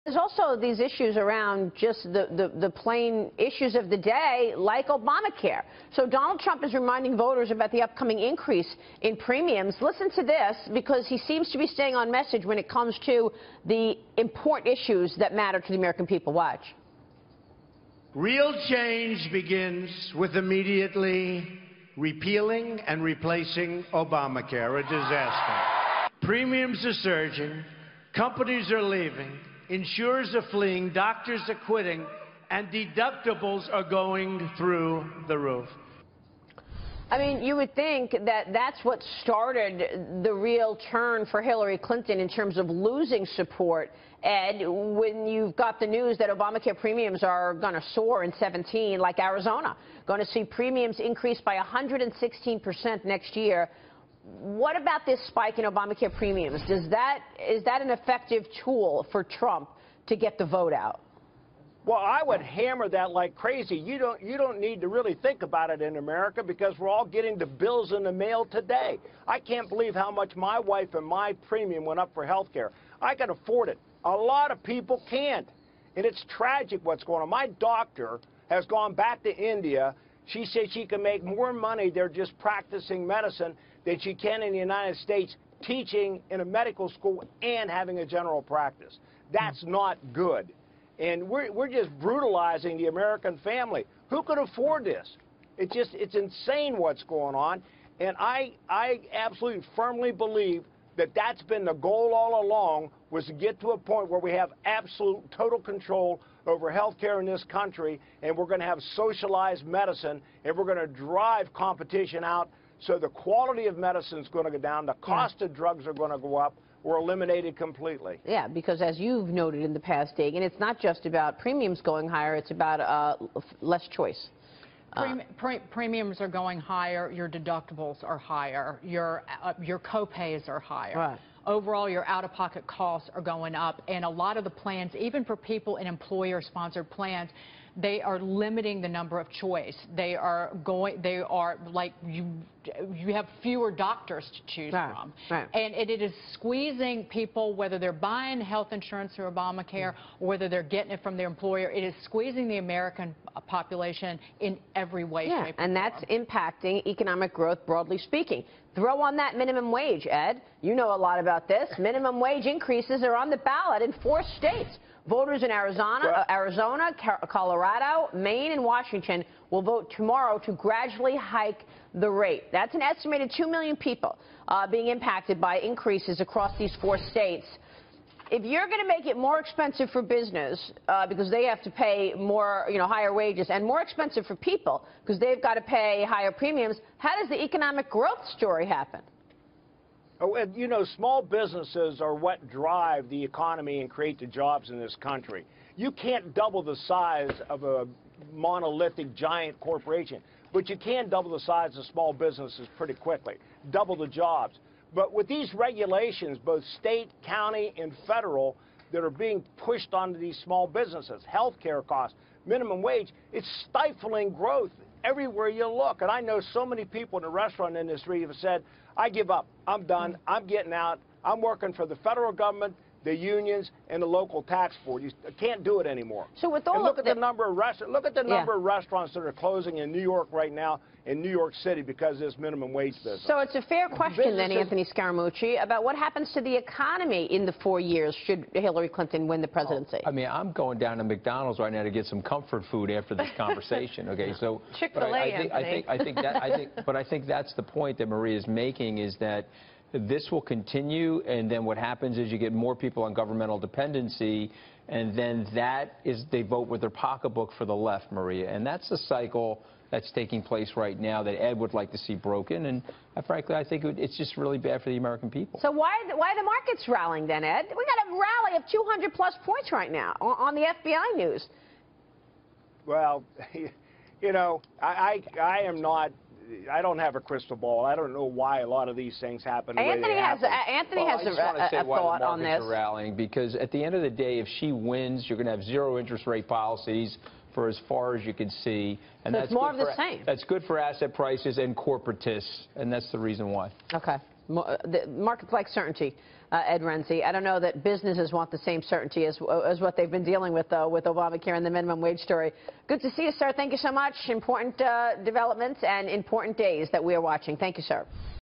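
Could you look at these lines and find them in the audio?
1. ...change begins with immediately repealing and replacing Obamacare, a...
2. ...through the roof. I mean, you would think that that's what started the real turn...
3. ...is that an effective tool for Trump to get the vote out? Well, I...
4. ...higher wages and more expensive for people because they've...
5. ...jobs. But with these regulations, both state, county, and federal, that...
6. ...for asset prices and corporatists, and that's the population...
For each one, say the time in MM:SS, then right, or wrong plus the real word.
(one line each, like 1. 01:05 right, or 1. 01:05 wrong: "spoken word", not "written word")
1. 00:18 right
2. 00:34 right
3. 00:57 right
4. 03:02 right
5. 03:24 right
6. 04:50 wrong: "reason", not "population".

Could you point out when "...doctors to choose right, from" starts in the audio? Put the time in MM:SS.
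02:23.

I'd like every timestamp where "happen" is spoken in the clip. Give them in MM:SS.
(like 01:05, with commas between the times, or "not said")
03:08, 03:55, 04:11, 04:39.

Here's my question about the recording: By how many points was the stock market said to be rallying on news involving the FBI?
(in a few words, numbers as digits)
200 plus.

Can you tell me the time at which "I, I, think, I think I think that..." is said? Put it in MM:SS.
04:05.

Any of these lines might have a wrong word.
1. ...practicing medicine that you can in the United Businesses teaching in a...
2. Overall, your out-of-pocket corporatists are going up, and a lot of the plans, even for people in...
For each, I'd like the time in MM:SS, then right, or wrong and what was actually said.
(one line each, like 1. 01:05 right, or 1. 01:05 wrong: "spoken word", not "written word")
1. 01:22 wrong: "States", not "Businesses"
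2. 02:11 wrong: "costs", not "corporatists".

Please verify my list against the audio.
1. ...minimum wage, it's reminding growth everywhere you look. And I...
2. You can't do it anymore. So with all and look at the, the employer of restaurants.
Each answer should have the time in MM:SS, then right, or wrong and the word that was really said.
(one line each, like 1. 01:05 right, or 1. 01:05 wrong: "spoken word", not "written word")
1. 03:32 wrong: "stifling", not "reminding"
2. 03:45 wrong: "number", not "employer".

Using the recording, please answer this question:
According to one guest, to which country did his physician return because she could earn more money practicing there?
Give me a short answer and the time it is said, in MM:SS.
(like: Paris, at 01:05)
India, at 01:19.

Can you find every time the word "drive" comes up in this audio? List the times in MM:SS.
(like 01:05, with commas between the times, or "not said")
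01:50, 03:12.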